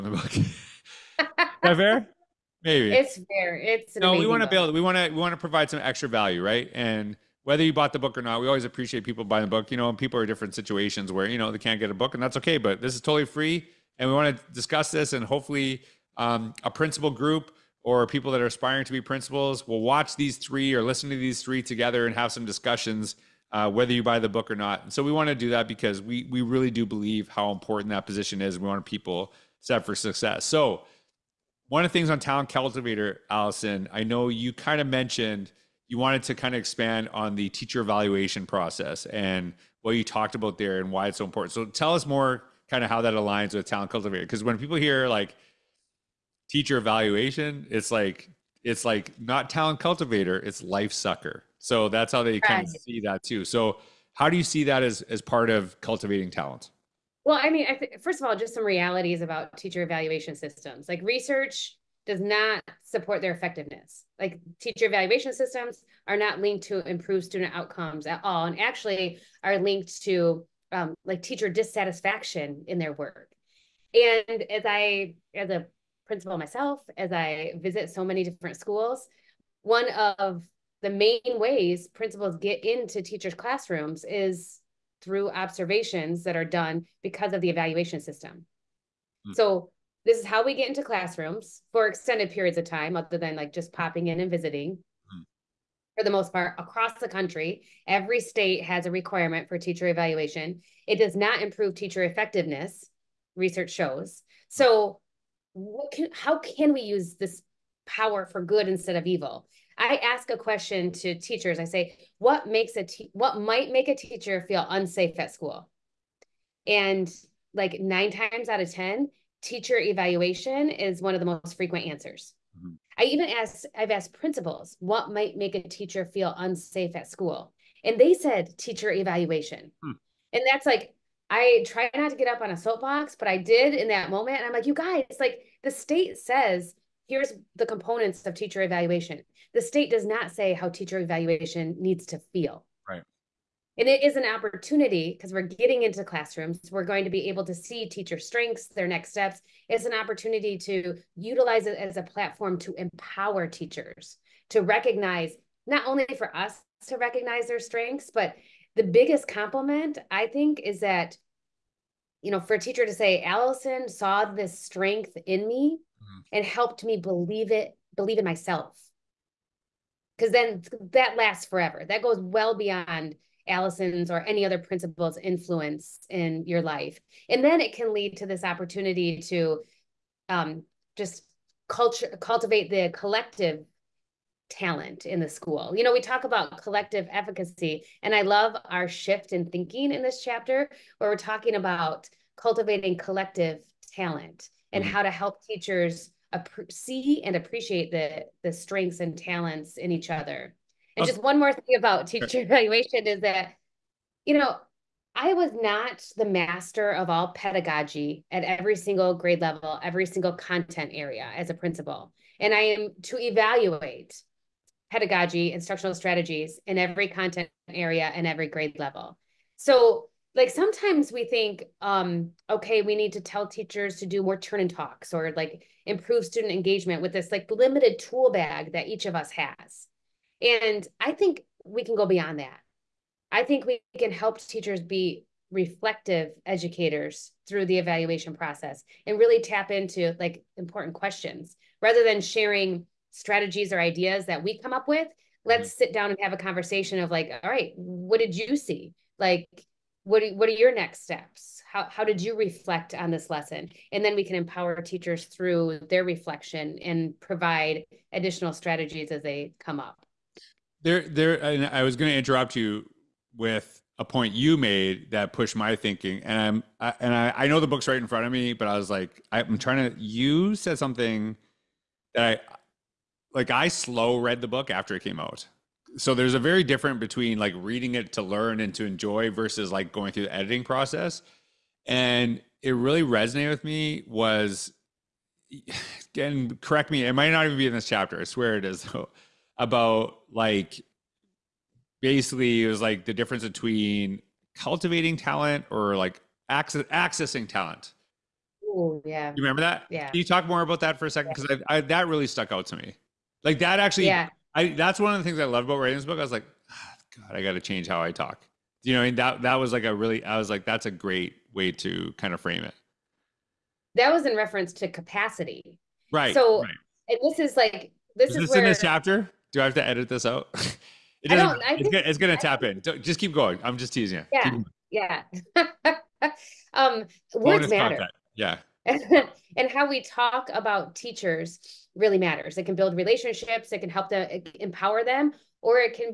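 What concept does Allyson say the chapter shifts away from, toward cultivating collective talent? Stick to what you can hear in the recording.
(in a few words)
collective efficacy.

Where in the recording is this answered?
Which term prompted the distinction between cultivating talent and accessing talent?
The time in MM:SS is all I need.
05:14.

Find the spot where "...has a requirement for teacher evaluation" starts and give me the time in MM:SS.
01:38.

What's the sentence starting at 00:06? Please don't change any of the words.
And whether you bought the book or not, we always appreciate people buying the book.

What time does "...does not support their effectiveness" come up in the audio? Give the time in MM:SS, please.
01:02.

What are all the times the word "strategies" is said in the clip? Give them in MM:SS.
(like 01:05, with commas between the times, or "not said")
03:35, 04:03, 04:18.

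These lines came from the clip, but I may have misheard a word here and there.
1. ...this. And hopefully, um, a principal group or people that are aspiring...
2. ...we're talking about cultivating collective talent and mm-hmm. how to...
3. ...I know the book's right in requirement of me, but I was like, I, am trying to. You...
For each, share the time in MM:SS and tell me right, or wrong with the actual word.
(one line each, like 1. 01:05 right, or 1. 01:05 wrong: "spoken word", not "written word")
1. 00:14 right
2. 03:11 right
3. 04:27 wrong: "front", not "requirement".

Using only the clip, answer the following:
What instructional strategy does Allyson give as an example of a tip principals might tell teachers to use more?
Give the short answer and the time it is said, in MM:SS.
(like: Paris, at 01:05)
turn and talks, at 03:44.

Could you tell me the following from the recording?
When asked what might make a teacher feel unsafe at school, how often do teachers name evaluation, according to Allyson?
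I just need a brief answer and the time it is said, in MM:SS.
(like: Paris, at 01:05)
9 times out of 10, at 01:57.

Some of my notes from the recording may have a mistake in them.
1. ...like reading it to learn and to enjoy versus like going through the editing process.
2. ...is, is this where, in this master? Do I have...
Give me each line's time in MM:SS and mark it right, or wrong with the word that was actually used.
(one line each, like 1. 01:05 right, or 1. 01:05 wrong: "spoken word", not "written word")
1. 04:37 right
2. 05:18 wrong: "chapter", not "master".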